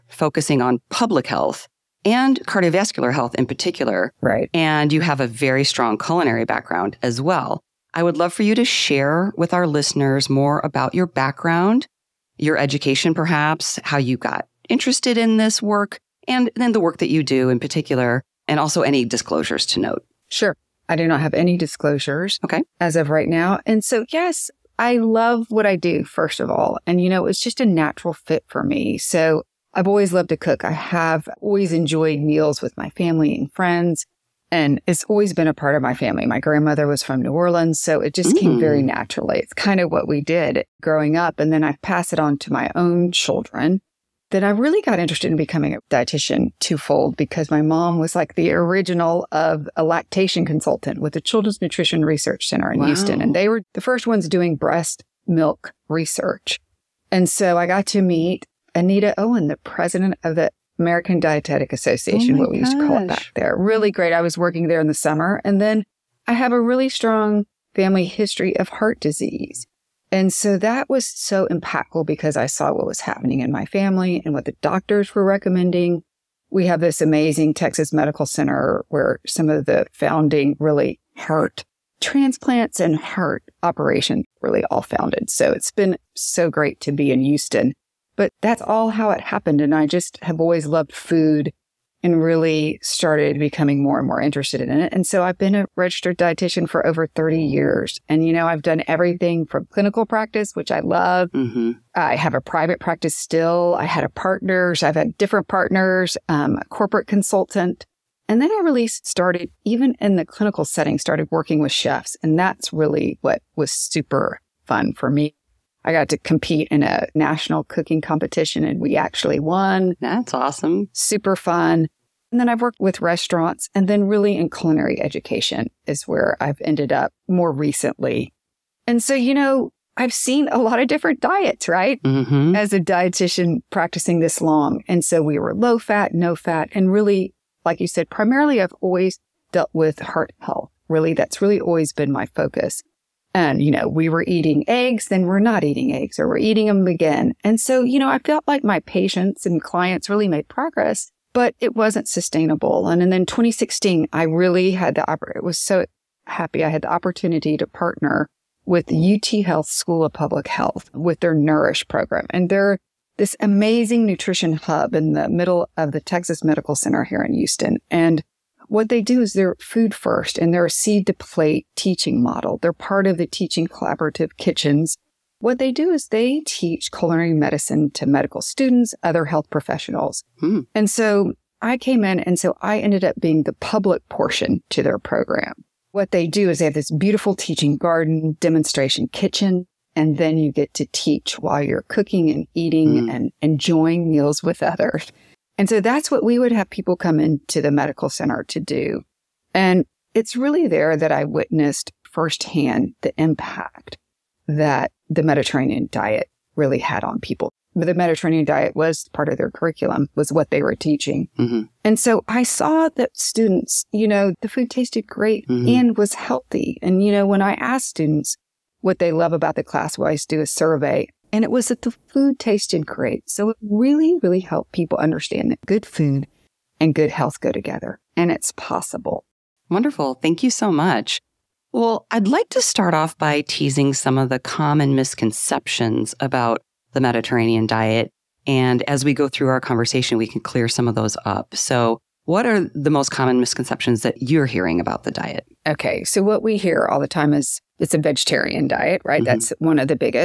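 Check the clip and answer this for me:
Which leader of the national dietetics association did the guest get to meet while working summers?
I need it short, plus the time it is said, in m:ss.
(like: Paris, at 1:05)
Anita Owen, at 0:58.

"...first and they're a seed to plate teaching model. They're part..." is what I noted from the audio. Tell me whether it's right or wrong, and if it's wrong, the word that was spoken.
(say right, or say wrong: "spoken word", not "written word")
right.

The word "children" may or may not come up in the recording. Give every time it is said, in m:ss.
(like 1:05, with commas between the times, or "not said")
0:43, 0:51.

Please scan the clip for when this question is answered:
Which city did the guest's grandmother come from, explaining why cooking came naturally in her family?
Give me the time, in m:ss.
0:37.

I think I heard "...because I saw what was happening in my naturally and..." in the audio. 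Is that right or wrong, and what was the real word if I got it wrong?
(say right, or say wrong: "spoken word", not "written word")
wrong: "family", not "naturally".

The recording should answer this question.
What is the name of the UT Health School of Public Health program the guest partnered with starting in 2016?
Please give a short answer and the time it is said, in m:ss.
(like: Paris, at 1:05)
Nourish, at 2:41.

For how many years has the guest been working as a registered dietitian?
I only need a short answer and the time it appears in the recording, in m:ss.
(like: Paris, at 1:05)
over 30, at 1:36.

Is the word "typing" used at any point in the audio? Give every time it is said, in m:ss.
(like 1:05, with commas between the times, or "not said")
not said.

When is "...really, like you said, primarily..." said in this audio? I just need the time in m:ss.
2:16.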